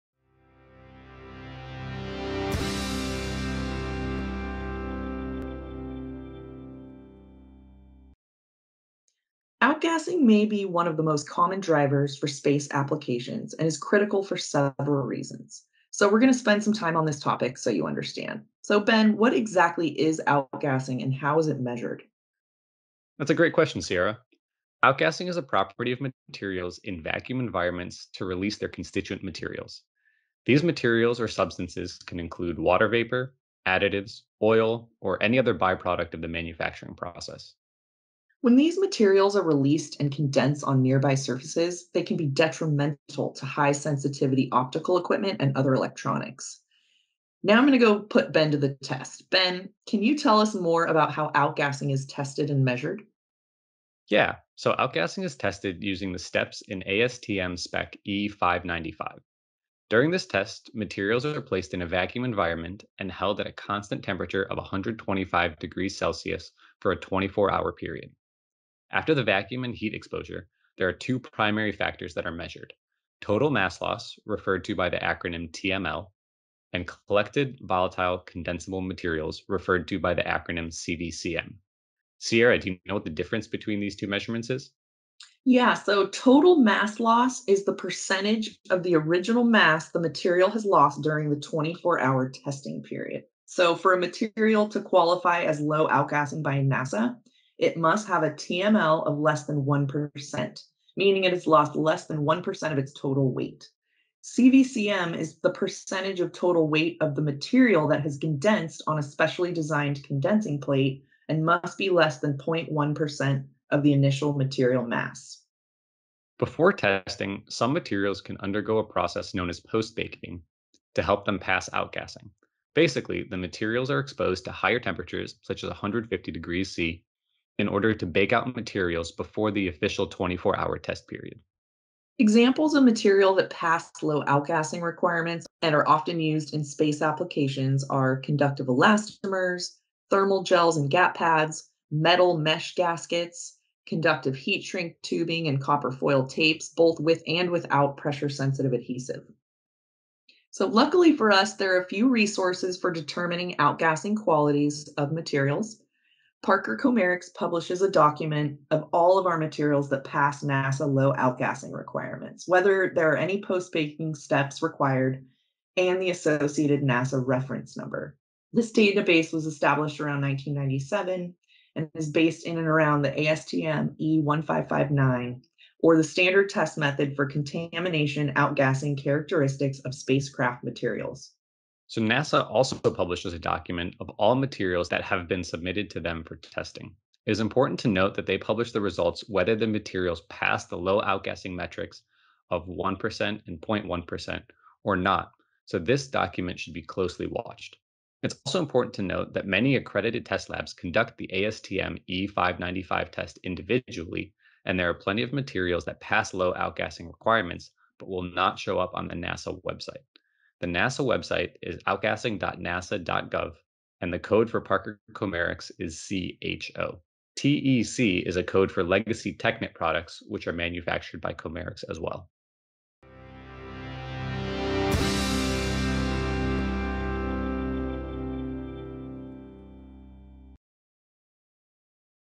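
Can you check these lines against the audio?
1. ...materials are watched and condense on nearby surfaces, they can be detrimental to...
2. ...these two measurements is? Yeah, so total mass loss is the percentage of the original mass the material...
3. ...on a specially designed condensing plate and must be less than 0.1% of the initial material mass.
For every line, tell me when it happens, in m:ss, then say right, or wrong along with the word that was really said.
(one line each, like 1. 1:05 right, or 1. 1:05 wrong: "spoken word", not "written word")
1. 0:38 wrong: "released", not "watched"
2. 1:23 right
3. 1:48 right.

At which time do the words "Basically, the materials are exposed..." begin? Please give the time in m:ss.
2:02.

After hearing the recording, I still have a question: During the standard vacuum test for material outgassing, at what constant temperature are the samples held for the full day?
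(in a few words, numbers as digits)
125 degrees Celsius.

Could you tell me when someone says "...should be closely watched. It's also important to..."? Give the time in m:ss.
3:16.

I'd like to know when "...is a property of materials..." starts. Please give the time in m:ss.
0:25.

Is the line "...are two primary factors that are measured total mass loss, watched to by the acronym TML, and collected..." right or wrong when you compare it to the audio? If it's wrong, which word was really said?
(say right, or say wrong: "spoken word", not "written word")
wrong: "referred", not "watched".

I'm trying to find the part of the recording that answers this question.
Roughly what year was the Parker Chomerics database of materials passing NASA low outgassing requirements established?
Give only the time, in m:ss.
2:50.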